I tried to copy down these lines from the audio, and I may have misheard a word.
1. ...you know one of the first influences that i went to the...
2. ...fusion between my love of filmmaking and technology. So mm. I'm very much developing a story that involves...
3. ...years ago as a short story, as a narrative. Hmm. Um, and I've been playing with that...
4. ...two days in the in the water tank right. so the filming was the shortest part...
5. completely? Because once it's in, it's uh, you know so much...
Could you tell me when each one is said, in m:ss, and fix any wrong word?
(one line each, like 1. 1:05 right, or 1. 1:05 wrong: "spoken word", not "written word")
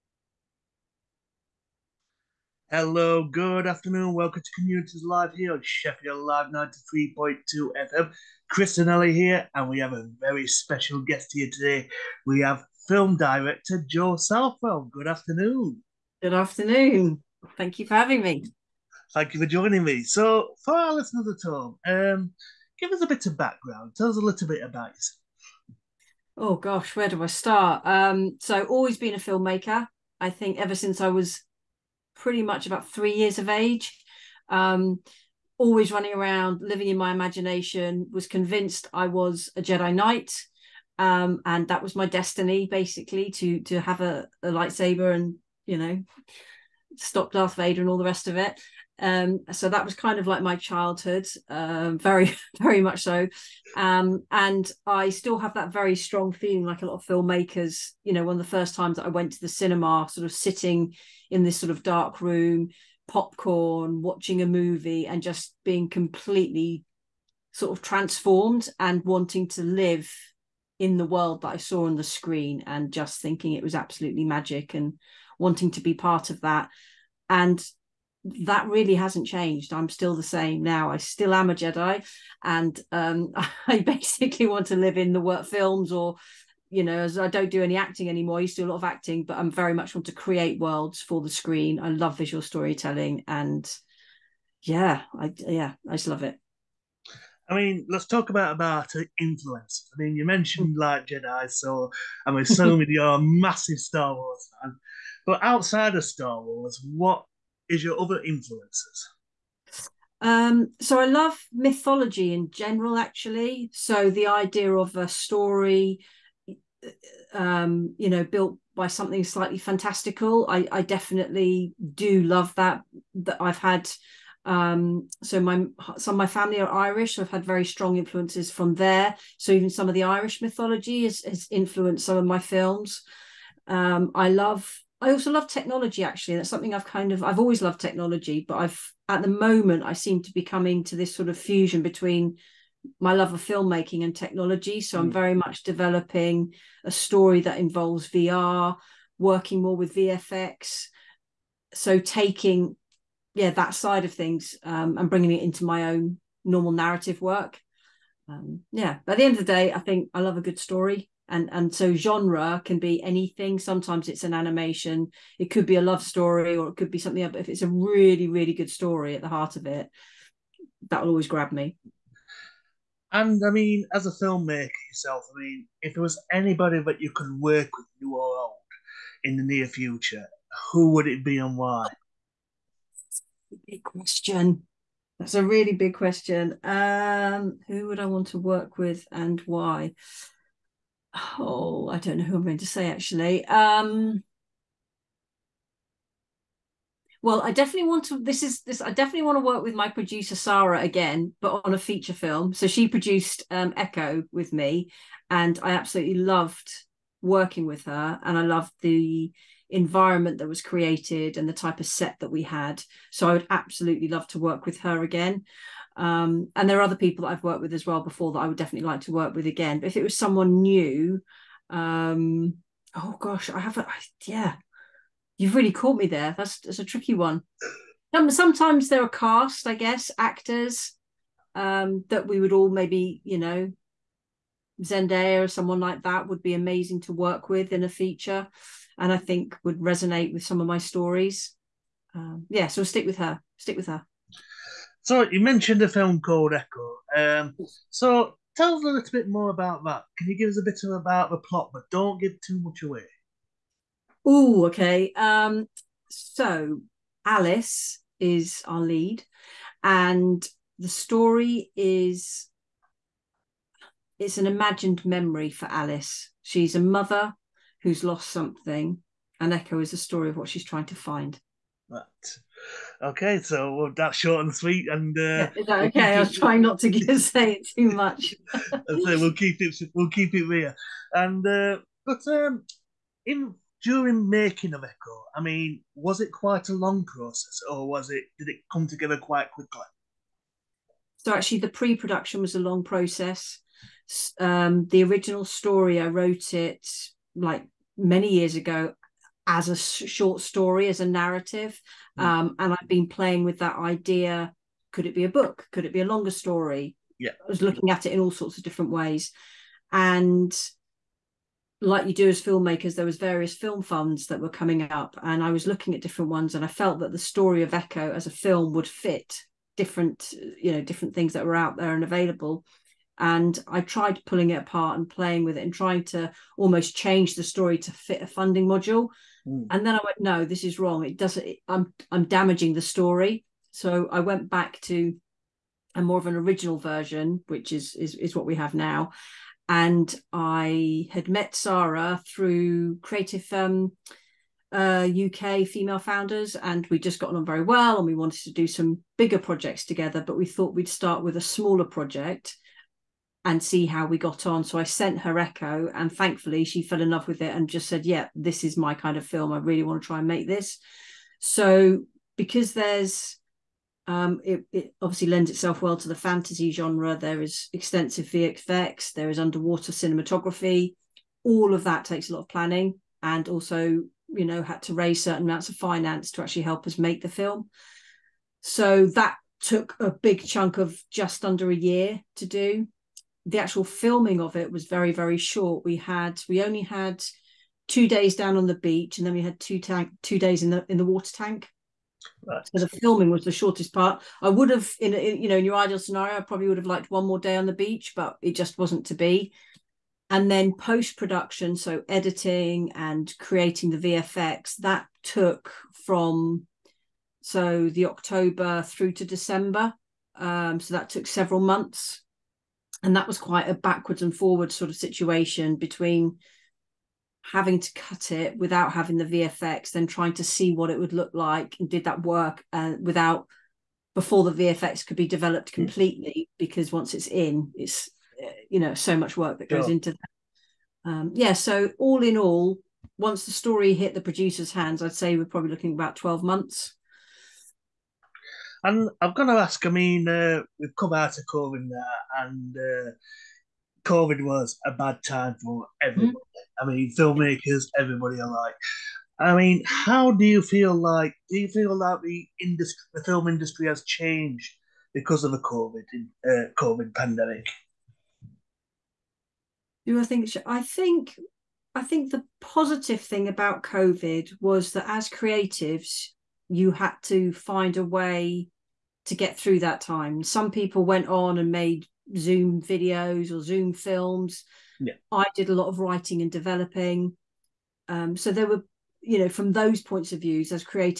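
1. 0:58 wrong: "times", not "influences"
2. 2:21 right
3. 4:58 right
4. 6:30 right
5. 7:05 right.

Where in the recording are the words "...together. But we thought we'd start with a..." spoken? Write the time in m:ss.
5:49.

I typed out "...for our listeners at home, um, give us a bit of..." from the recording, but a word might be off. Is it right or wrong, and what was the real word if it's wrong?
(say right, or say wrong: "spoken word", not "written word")
right.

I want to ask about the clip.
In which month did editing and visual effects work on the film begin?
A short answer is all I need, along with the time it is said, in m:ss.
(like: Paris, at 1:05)
October, at 6:48.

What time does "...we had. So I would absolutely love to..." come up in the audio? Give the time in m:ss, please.
3:32.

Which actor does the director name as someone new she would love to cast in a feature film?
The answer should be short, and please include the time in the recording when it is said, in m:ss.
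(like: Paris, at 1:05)
Zendaya, at 3:54.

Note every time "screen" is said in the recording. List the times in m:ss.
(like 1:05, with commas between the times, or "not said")
1:12, 1:31.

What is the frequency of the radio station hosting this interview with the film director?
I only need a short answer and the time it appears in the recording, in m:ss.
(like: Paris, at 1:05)
93.2 FM, at 0:06.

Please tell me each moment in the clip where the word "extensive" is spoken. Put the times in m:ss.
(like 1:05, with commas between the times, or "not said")
6:07.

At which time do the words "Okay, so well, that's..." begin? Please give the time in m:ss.
4:32.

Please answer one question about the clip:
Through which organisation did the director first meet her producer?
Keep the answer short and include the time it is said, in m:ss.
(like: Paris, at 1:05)
UK female founders, at 5:45.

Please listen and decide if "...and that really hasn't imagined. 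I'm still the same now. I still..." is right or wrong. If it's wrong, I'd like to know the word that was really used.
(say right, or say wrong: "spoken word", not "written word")
wrong: "changed", not "imagined".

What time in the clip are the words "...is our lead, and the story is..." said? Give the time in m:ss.
4:18.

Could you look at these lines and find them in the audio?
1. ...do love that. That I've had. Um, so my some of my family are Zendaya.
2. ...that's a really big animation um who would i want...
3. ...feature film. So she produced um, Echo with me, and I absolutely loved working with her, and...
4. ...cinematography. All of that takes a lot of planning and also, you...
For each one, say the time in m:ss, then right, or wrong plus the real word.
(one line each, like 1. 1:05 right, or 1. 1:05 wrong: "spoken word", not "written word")
1. 2:01 wrong: "Irish", not "Zendaya"
2. 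3:05 wrong: "question", not "animation"
3. 3:21 right
4. 6:09 right.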